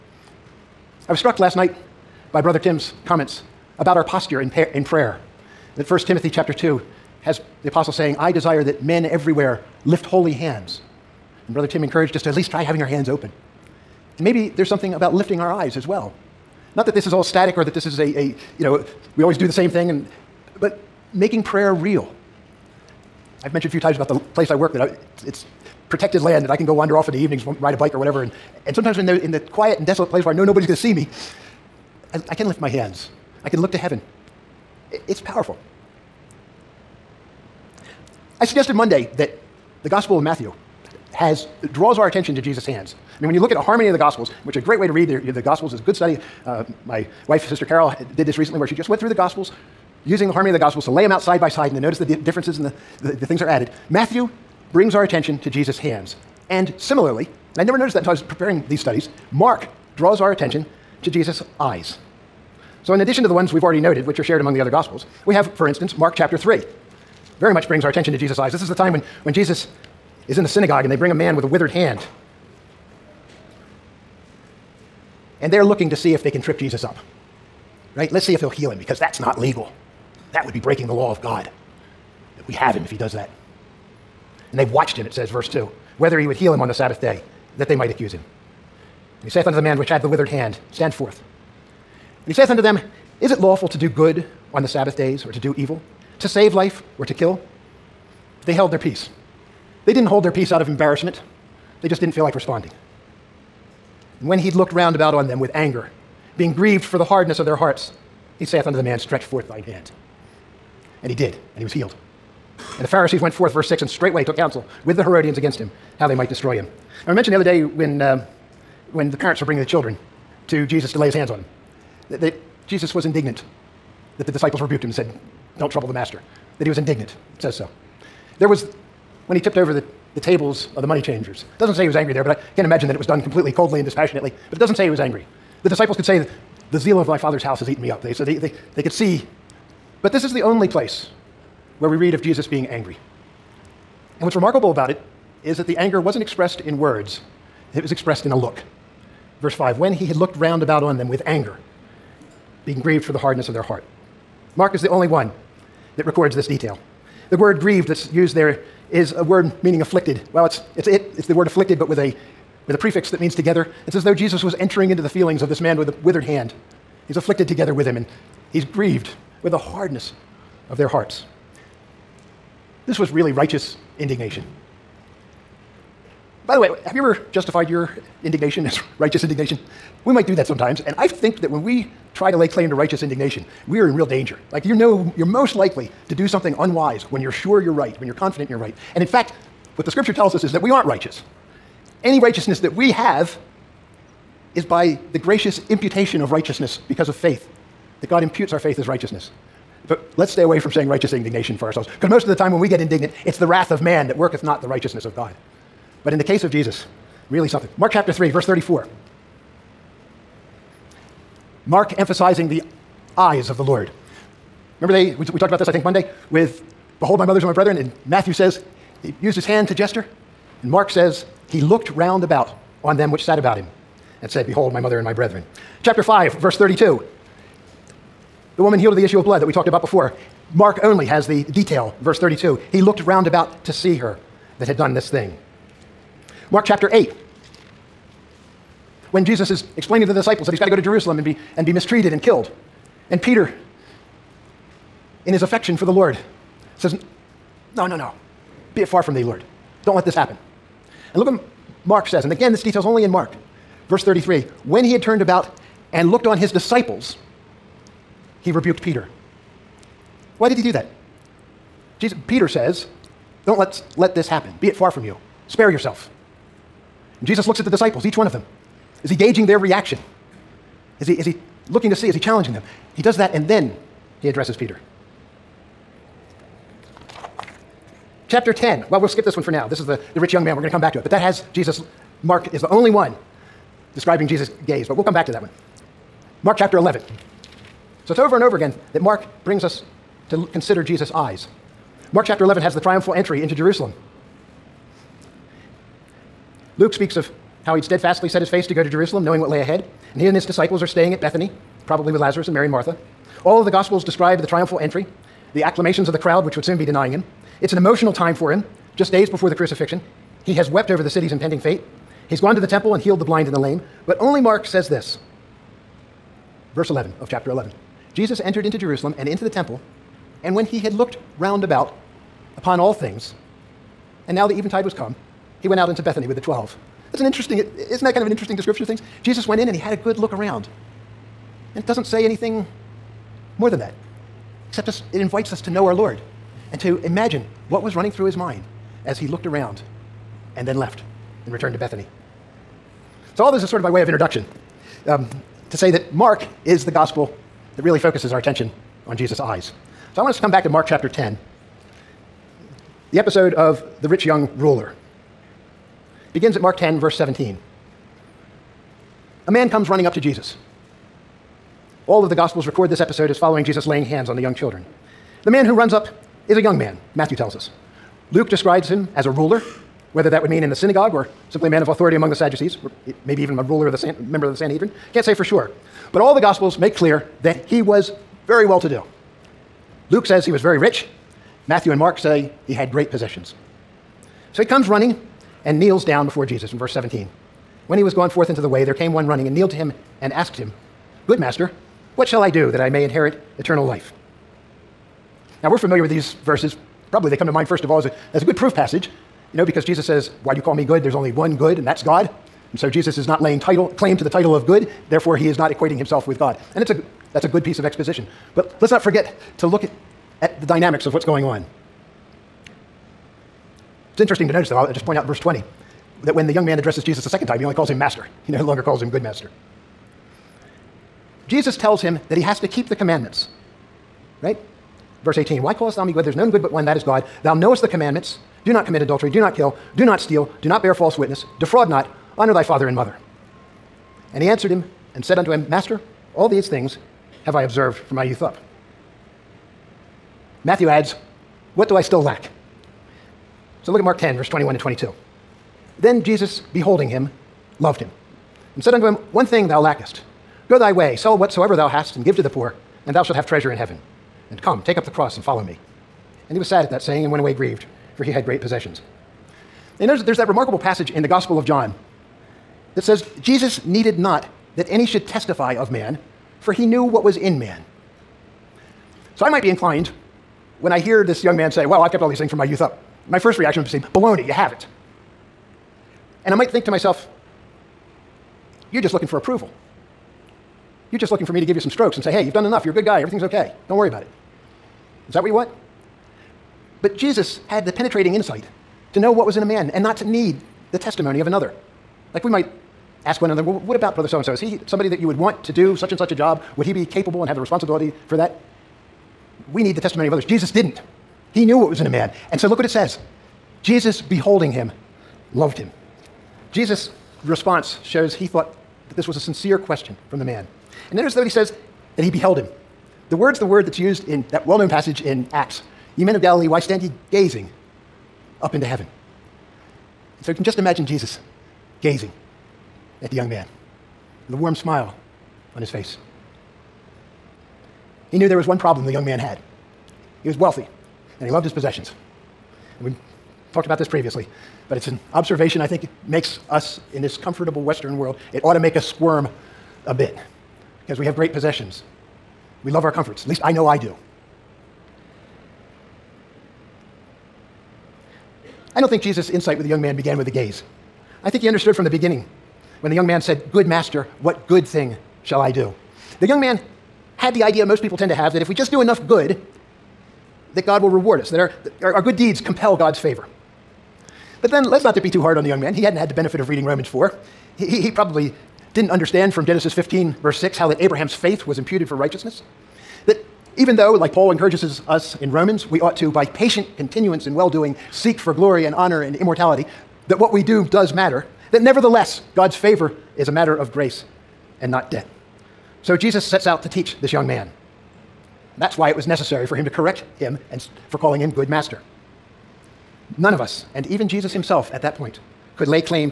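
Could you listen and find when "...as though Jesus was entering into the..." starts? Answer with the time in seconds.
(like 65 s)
163 s.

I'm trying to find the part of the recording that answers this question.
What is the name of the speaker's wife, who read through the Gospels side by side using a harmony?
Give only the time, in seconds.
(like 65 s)
47 s.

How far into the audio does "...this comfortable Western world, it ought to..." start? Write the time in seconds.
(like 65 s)
537 s.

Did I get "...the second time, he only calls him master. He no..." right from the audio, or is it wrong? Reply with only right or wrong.
right.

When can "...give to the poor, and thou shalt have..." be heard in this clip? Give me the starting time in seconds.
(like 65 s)
452 s.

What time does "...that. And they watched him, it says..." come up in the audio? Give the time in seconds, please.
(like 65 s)
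83 s.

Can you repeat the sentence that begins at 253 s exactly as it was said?
Verse 33 When he had turned about and looked on his disciples, he rebuked Peter.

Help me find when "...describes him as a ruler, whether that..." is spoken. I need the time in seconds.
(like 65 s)
368 s.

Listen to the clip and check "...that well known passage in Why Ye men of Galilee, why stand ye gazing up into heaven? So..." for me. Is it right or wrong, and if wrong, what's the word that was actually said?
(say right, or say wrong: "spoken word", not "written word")
wrong: "Acts", not "Why".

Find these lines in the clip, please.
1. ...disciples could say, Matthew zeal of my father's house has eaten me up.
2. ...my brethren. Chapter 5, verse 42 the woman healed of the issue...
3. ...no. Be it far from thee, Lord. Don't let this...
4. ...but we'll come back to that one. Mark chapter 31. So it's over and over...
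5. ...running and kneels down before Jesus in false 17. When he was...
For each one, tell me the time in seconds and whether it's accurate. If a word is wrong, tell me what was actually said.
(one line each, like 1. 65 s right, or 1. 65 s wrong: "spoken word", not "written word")
1. 135 s wrong: "The", not "Matthew"
2. 225 s wrong: "32", not "42"
3. 247 s right
4. 284 s wrong: "11", not "31"
5. 384 s wrong: "verse", not "false".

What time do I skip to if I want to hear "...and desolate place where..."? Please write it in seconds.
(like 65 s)
29 s.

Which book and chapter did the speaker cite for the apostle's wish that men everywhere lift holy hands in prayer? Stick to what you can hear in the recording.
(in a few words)
1 Timothy chapter 2.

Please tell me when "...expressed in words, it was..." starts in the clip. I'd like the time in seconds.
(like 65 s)
146 s.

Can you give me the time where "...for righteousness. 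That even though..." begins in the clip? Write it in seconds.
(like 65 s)
572 s.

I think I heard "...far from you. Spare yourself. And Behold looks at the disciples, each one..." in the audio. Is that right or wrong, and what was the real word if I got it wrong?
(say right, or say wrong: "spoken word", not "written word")
wrong: "Jesus", not "Behold".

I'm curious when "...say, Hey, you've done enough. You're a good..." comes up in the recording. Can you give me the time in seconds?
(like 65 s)
482 s.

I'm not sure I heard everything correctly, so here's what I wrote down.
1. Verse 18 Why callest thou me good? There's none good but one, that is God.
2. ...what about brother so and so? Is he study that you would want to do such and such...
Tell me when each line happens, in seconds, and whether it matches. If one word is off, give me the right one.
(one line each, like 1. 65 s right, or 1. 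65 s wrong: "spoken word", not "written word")
1. 425 s right
2. 493 s wrong: "somebody", not "study".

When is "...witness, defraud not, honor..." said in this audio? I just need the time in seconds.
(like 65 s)
431 s.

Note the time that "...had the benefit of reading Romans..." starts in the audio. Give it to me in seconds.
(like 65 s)
566 s.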